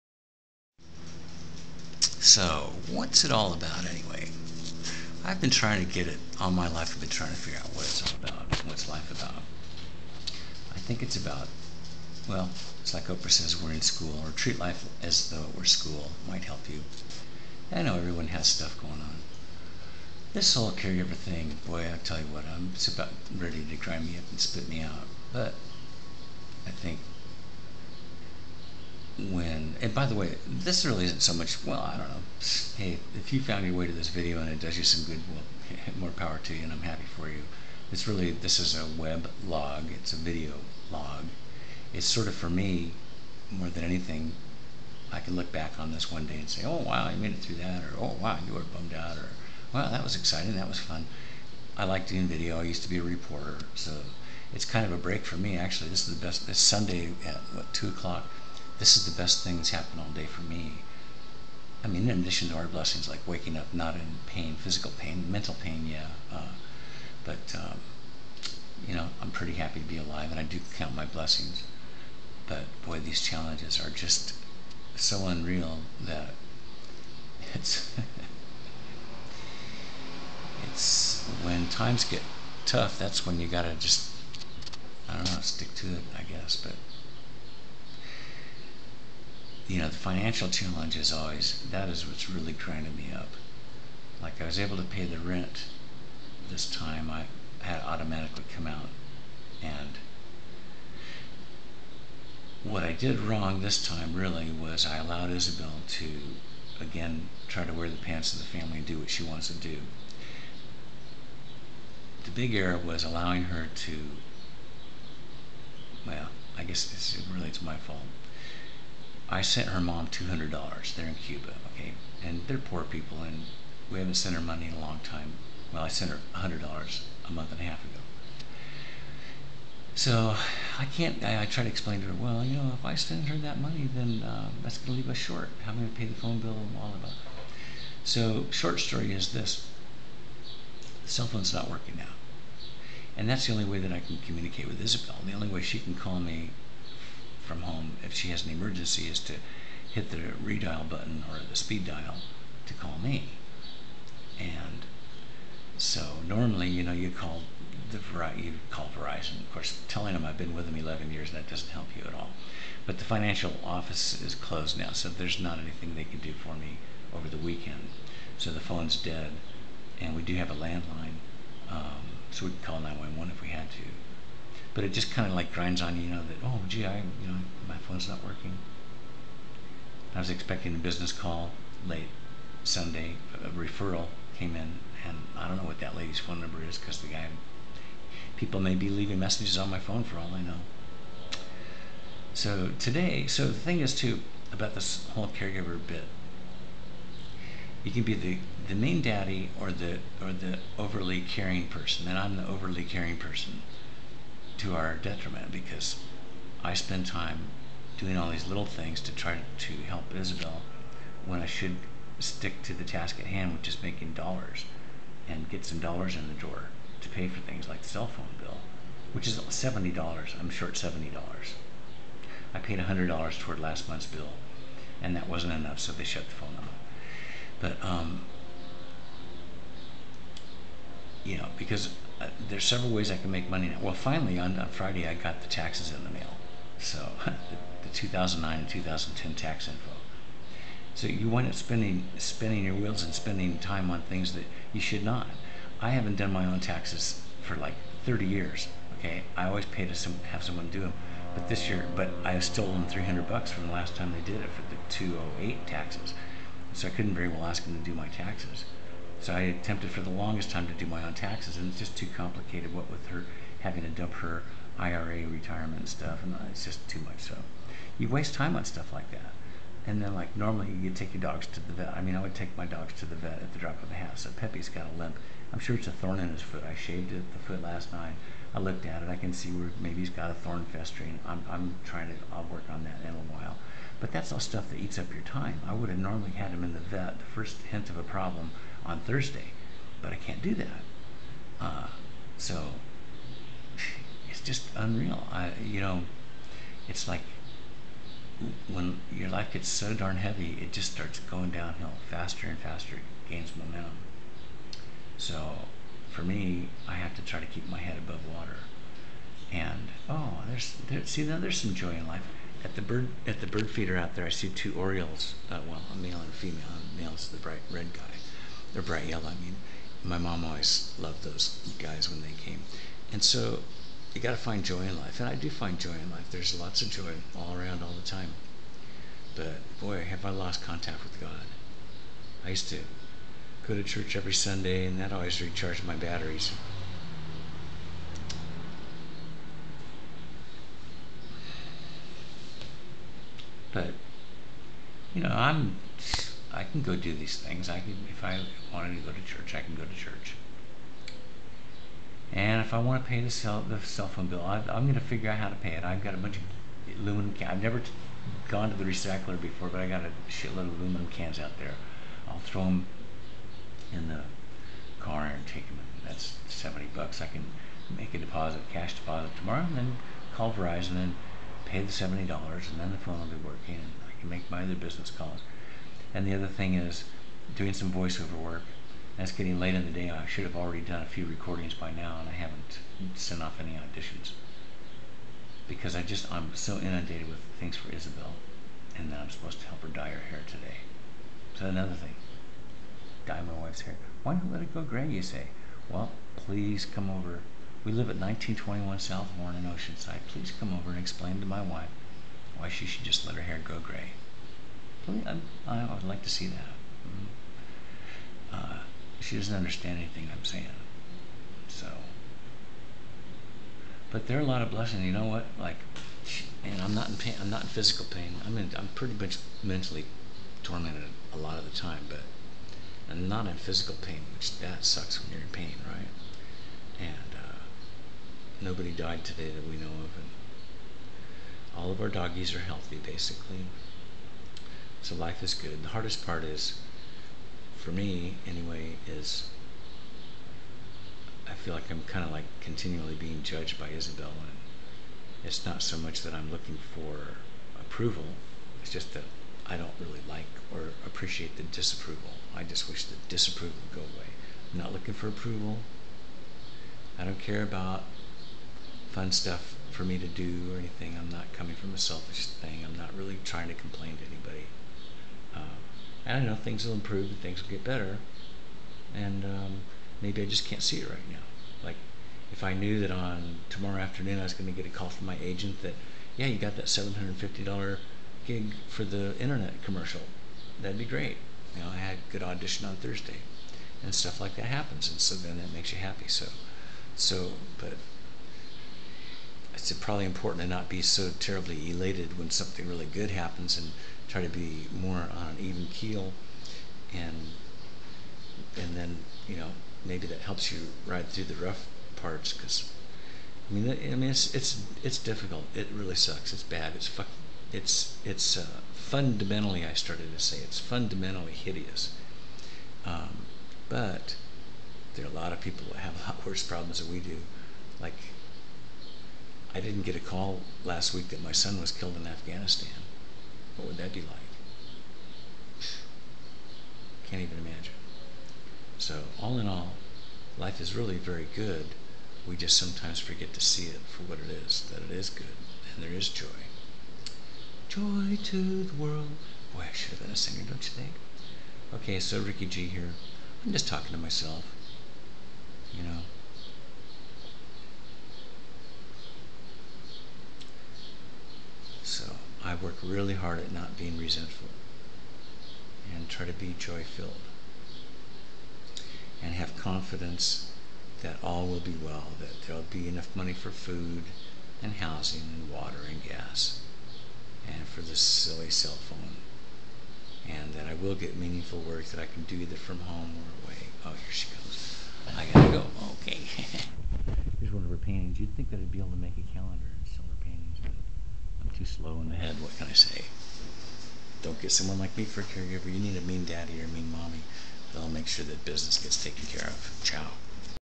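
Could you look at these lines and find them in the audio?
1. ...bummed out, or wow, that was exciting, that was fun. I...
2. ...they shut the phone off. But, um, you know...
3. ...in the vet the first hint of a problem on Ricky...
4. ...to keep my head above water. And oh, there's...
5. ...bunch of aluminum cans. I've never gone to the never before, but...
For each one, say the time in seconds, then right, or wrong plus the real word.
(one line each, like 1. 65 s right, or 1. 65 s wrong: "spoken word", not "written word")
1. 48 s right
2. 225 s right
3. 286 s wrong: "Thursday", not "Ricky"
4. 307 s right
5. 356 s wrong: "recycler", not "never".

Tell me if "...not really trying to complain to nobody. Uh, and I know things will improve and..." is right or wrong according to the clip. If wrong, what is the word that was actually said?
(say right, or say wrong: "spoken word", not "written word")
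wrong: "anybody", not "nobody".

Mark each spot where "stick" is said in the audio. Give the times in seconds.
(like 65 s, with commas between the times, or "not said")
85 s, 212 s.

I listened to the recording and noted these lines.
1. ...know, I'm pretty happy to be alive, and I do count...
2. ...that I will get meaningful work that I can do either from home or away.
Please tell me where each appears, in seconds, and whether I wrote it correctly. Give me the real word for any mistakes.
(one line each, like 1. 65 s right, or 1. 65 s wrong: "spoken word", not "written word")
1. 68 s right
2. 570 s right.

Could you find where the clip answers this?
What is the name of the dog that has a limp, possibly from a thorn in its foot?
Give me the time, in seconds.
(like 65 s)
274 s.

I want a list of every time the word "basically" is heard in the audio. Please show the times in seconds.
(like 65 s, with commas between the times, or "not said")
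432 s.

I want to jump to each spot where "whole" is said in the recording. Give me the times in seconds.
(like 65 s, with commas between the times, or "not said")
20 s, 195 s.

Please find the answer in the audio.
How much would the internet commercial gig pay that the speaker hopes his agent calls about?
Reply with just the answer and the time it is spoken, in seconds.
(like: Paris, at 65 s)
$750, at 476 s.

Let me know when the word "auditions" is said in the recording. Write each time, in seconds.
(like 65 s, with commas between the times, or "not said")
383 s, 482 s.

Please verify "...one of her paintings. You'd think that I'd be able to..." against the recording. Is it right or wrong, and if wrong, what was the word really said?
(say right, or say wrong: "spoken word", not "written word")
right.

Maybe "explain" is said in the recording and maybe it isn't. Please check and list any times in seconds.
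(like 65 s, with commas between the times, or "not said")
131 s, 400 s.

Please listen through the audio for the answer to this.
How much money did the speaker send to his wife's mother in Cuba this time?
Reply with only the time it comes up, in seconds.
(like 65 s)
120 s.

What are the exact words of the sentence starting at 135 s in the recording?
How am I going to pay the phone bill and all of that?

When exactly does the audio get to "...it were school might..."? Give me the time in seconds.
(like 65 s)
15 s.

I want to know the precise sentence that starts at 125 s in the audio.
Well, I sent her $100 a month and a half ago.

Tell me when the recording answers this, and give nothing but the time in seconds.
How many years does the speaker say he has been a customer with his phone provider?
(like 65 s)
160 s.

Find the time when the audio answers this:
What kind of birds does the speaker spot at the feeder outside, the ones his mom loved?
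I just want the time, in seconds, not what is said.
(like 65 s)
314 s.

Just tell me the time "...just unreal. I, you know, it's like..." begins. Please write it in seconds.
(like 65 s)
294 s.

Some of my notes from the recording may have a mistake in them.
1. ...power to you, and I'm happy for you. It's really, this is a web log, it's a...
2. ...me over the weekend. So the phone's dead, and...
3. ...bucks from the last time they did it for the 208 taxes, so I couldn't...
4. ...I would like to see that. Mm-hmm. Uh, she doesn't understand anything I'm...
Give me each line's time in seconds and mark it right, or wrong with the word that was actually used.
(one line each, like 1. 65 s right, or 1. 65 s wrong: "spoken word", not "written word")
1. 36 s right
2. 166 s right
3. 253 s right
4. 405 s right.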